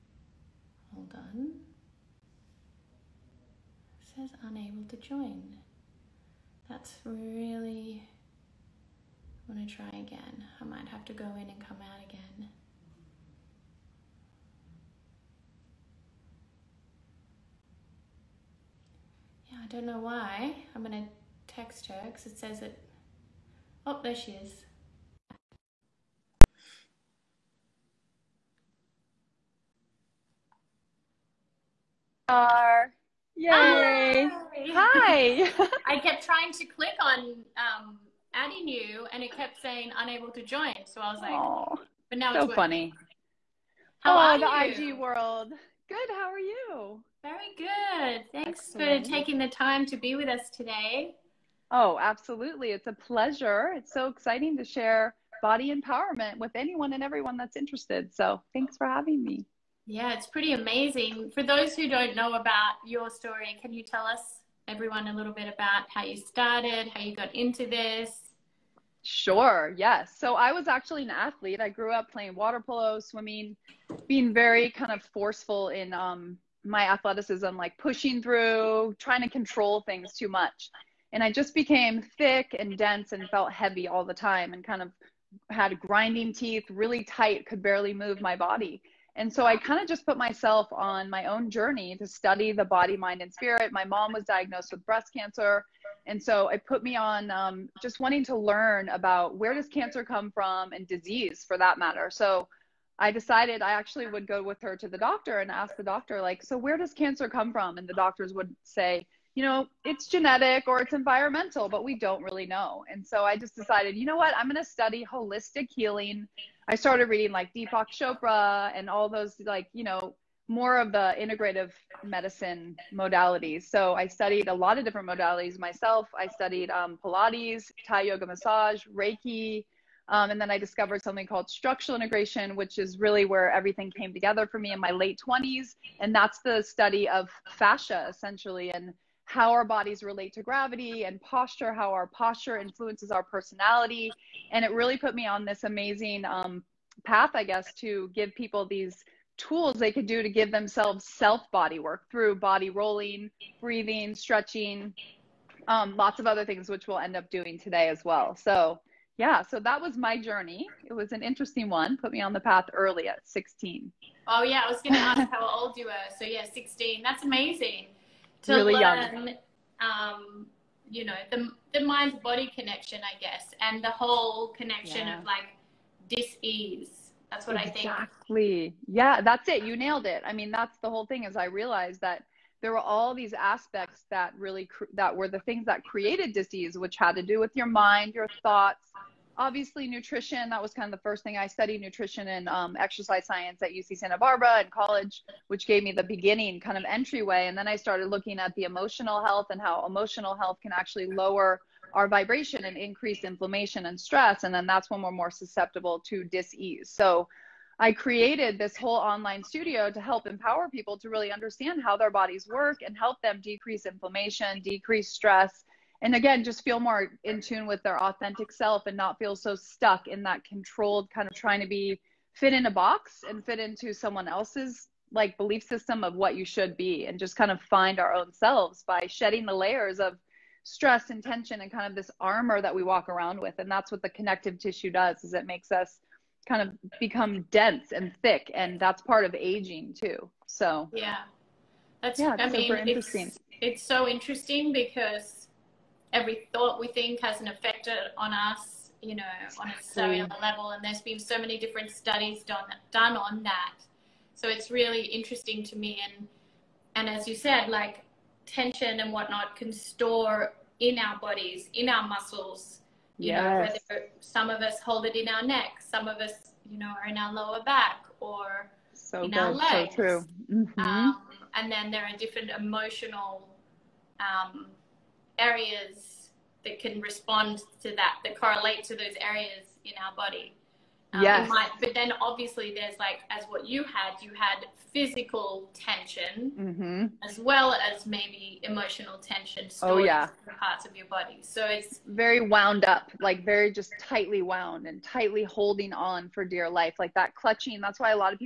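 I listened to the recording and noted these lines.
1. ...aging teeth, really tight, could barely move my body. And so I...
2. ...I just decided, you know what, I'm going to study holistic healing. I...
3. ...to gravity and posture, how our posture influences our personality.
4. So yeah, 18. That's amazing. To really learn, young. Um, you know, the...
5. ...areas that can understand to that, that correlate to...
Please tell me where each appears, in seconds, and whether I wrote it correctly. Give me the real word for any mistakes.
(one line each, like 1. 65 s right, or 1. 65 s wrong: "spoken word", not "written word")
1. 85 s wrong: "grinding", not "aging"
2. 113 s right
3. 140 s right
4. 166 s wrong: "16", not "18"
5. 275 s wrong: "respond", not "understand".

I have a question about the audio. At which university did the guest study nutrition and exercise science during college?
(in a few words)
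UC Santa Barbara.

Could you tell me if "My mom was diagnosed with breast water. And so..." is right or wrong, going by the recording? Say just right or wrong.
wrong.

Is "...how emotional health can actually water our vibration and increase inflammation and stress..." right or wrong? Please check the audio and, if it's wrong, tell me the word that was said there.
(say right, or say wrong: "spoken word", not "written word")
wrong: "lower", not "water".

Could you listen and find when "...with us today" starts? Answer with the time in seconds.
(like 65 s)
50 s.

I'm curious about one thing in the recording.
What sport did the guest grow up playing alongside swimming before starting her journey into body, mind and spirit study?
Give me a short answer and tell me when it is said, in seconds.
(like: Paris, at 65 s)
water polo, at 72 s.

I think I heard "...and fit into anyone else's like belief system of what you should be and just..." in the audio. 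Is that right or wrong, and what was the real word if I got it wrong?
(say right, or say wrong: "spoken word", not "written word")
wrong: "someone", not "anyone".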